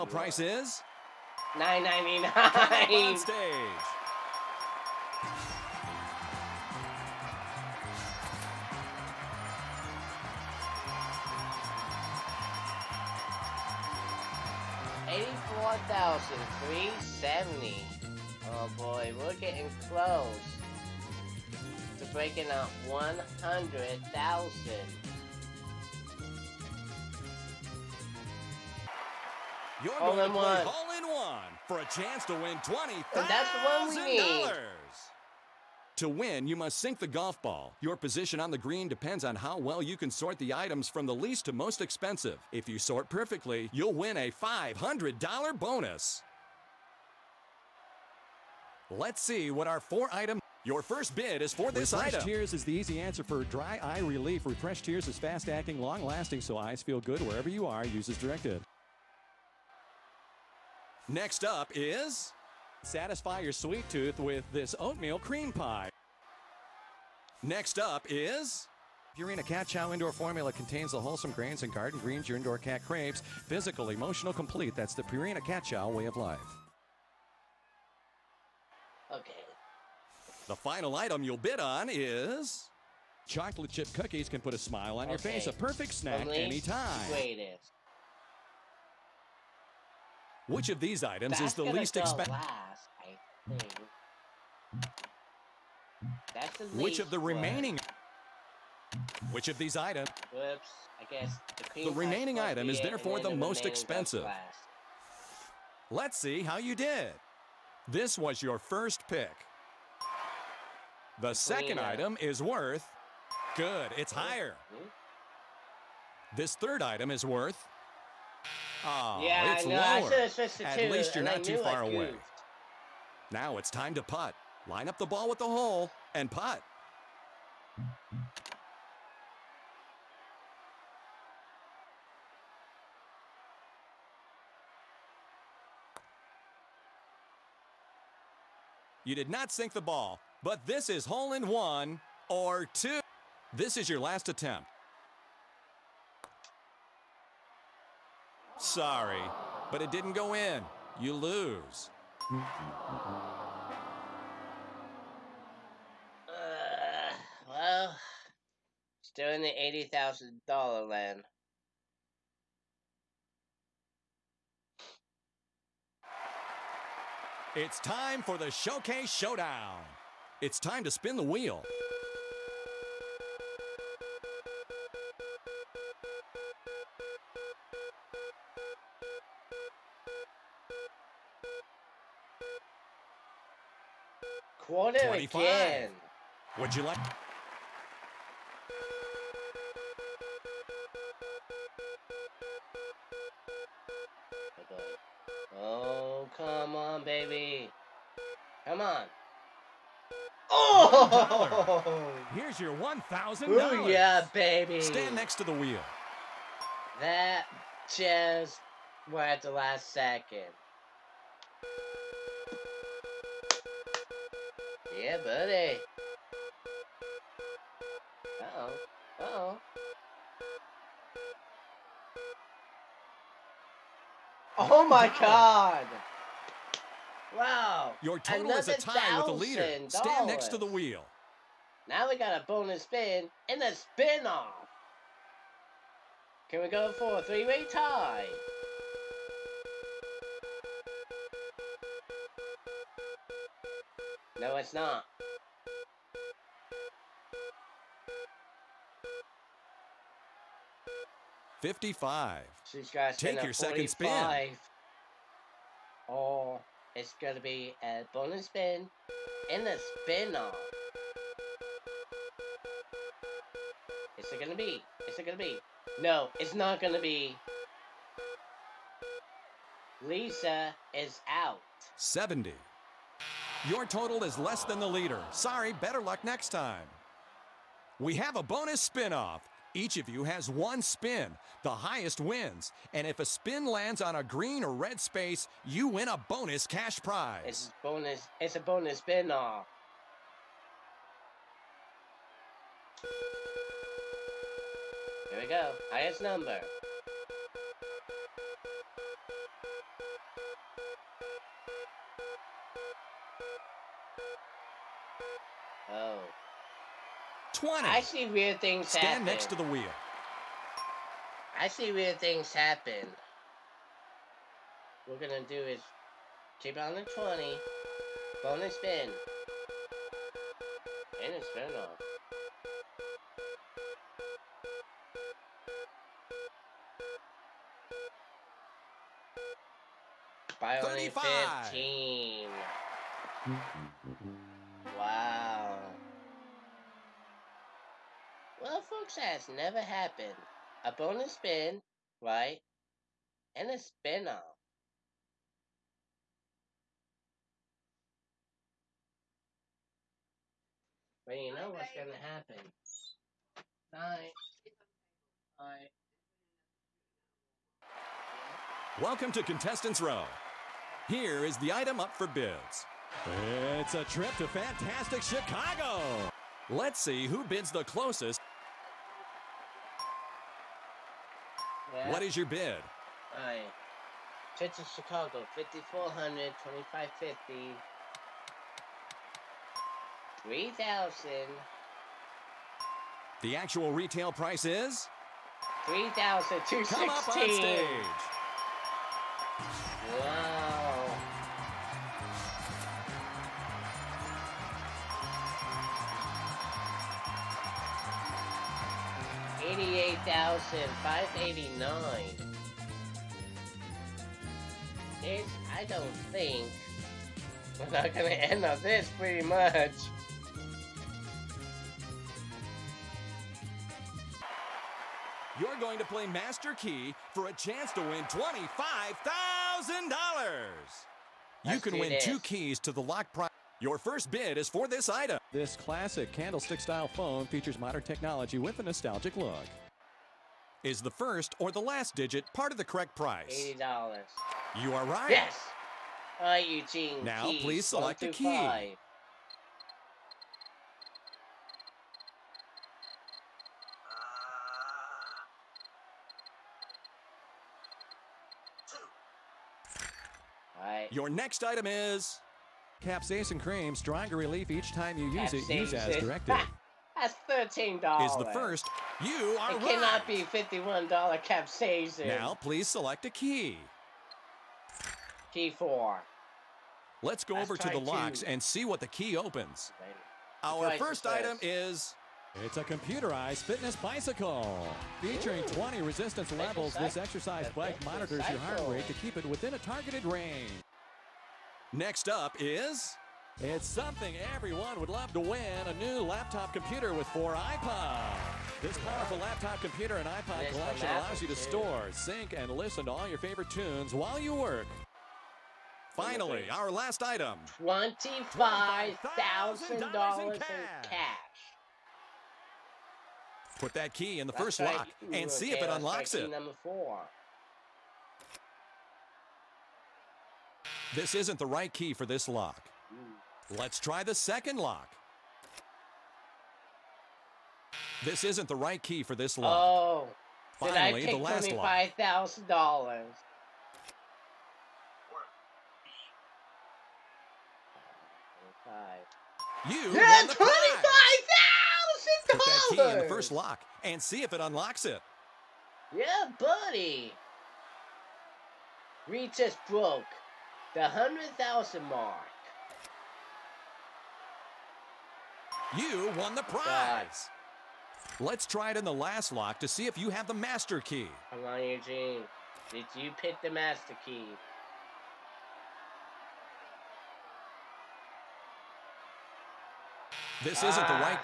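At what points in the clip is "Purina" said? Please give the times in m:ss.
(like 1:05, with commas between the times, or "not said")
1:09, 1:15.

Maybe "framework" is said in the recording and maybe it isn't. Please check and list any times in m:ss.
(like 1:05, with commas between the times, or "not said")
not said.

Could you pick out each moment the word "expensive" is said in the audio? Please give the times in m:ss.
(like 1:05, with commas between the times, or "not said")
0:41, 1:31, 1:43.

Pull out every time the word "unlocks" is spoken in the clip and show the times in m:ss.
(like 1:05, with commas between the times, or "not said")
8:25, 8:54.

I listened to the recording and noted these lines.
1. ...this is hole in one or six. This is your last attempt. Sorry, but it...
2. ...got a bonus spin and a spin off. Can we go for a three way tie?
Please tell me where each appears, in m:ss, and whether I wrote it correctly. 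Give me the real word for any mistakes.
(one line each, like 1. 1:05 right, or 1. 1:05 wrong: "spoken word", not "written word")
1. 2:20 wrong: "two", not "six"
2. 3:52 right.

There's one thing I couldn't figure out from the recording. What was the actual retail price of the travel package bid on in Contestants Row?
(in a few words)
3216.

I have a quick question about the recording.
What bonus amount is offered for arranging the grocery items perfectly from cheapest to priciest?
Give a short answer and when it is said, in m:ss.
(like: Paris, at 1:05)
$500, at 0:44.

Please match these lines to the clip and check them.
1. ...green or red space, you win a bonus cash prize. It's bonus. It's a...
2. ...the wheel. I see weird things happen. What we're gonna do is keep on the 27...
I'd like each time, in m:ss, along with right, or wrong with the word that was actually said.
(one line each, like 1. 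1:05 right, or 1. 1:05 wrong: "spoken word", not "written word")
1. 4:44 right
2. 5:09 wrong: "20", not "27".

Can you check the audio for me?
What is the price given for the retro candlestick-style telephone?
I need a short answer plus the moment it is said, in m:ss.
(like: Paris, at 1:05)
$80, at 7:13.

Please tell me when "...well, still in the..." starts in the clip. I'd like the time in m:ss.
2:37.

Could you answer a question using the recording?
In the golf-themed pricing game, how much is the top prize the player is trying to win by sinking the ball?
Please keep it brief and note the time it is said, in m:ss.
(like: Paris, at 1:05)
$20,000, at 0:32.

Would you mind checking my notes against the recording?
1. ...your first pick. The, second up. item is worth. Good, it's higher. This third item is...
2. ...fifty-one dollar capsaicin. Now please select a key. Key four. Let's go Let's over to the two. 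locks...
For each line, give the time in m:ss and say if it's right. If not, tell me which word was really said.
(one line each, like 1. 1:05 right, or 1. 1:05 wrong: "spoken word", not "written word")
1. 1:48 right
2. 7:40 right.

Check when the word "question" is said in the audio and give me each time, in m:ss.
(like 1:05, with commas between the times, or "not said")
not said.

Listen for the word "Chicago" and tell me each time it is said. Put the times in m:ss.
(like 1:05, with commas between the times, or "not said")
6:05, 6:14.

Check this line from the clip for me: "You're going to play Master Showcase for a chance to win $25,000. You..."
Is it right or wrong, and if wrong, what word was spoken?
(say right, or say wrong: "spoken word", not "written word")
wrong: "Key", not "Showcase".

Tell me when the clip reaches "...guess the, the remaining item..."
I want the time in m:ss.
1:41.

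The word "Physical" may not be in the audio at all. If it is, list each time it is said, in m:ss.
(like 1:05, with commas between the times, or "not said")
1:13.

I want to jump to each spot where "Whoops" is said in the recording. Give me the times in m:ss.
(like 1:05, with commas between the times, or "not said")
1:40.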